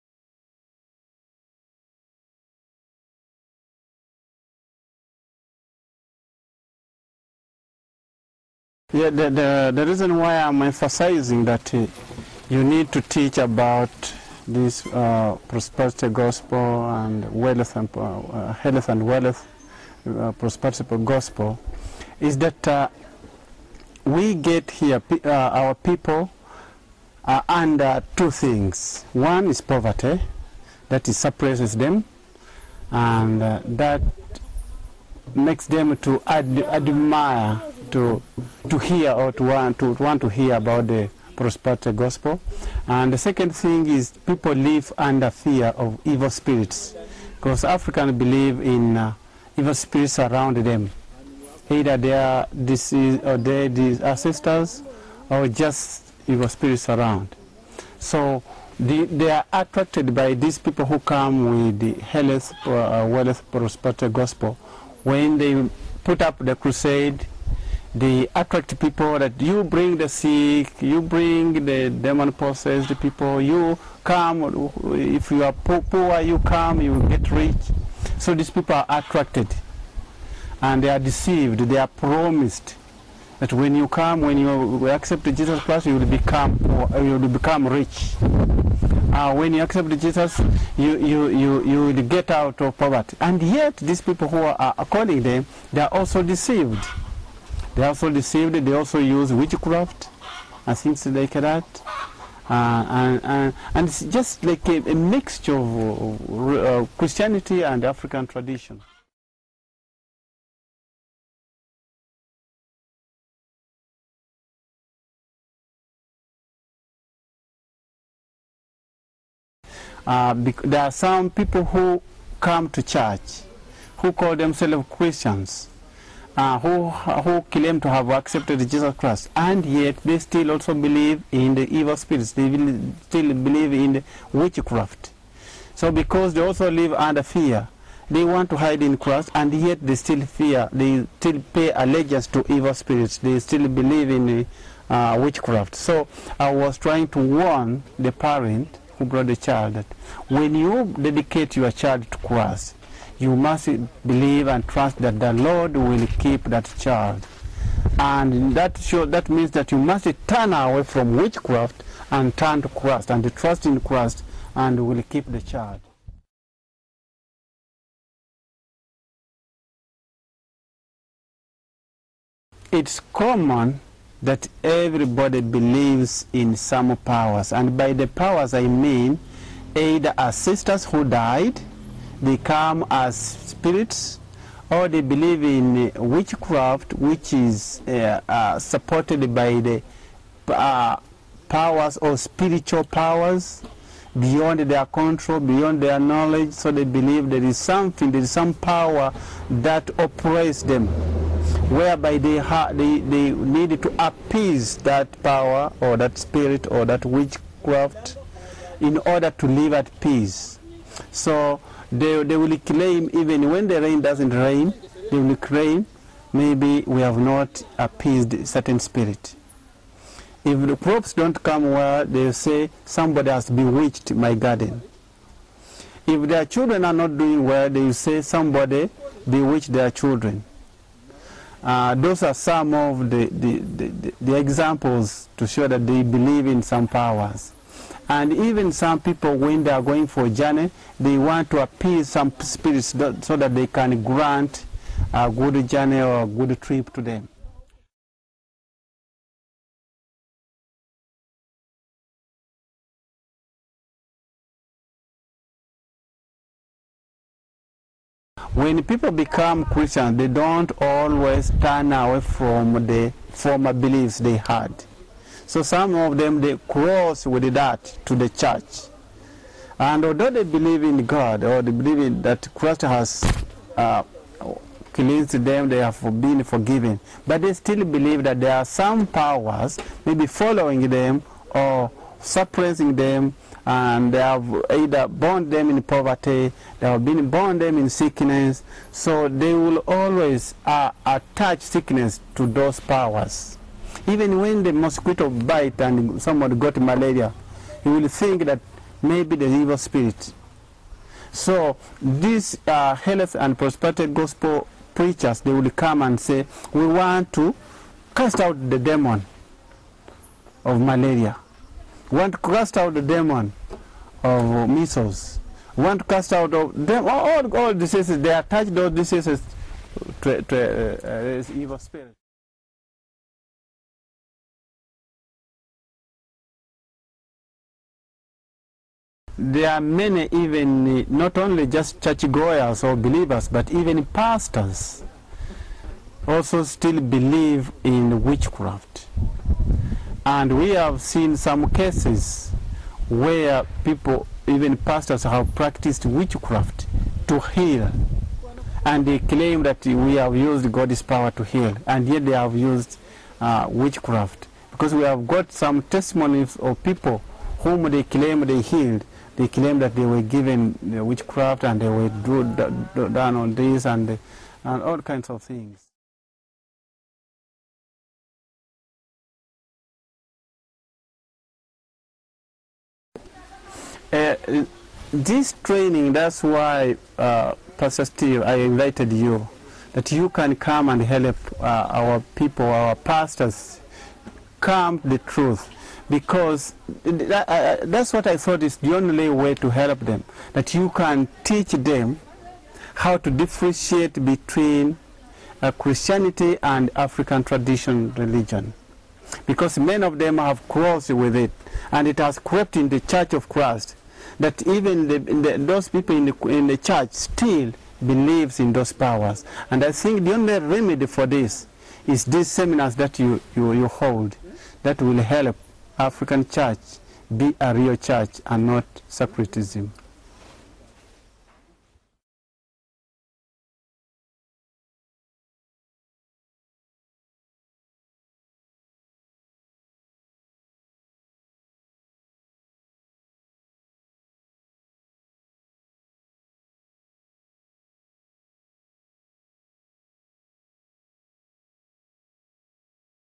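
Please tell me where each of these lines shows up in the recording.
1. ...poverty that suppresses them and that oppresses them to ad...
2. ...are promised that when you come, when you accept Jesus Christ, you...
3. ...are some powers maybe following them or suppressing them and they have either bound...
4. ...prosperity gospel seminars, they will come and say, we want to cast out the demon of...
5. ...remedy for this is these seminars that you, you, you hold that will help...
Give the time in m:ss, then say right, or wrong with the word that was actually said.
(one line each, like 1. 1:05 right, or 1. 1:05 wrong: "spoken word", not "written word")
1. 0:29 wrong: "makes", not "oppresses"
2. 1:21 right
3. 4:38 right
4. 5:03 wrong: "preachers", not "seminars"
5. 6:50 right.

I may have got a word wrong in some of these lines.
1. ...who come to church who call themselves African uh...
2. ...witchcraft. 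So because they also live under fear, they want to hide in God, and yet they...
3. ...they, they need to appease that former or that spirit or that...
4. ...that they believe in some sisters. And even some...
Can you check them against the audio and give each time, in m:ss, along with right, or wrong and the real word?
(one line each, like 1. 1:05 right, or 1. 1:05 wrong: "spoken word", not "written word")
1. 2:01 wrong: "Christians", not "African"
2. 2:14 wrong: "Christ", not "God"
3. 3:22 wrong: "power", not "former"
4. 3:55 wrong: "powers", not "sisters".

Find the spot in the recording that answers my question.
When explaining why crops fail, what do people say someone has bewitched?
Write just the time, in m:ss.
3:44.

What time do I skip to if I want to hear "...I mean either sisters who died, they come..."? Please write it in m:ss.
2:58.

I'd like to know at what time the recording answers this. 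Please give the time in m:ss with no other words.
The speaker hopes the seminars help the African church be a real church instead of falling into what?
6:59.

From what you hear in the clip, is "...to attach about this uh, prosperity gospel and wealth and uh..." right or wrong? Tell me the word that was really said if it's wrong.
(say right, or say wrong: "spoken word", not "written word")
wrong: "teach", not "attach".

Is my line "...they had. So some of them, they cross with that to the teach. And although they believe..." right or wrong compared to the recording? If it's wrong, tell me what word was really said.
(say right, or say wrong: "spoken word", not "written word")
wrong: "church", not "teach".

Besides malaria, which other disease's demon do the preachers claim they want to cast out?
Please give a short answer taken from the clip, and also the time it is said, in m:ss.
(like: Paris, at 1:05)
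measles, at 5:14.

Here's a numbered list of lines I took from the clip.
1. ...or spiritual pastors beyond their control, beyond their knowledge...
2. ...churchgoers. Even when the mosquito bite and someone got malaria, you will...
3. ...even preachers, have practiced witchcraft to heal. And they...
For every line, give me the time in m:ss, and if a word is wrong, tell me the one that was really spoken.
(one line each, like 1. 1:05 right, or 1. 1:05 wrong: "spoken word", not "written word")
1. 3:11 wrong: "powers", not "pastors"
2. 4:52 wrong: "powers", not "churchgoers"
3. 5:44 wrong: "pastors", not "preachers".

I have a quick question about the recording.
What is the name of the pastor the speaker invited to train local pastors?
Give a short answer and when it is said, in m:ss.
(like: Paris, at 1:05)
Pastor Steve, at 6:17.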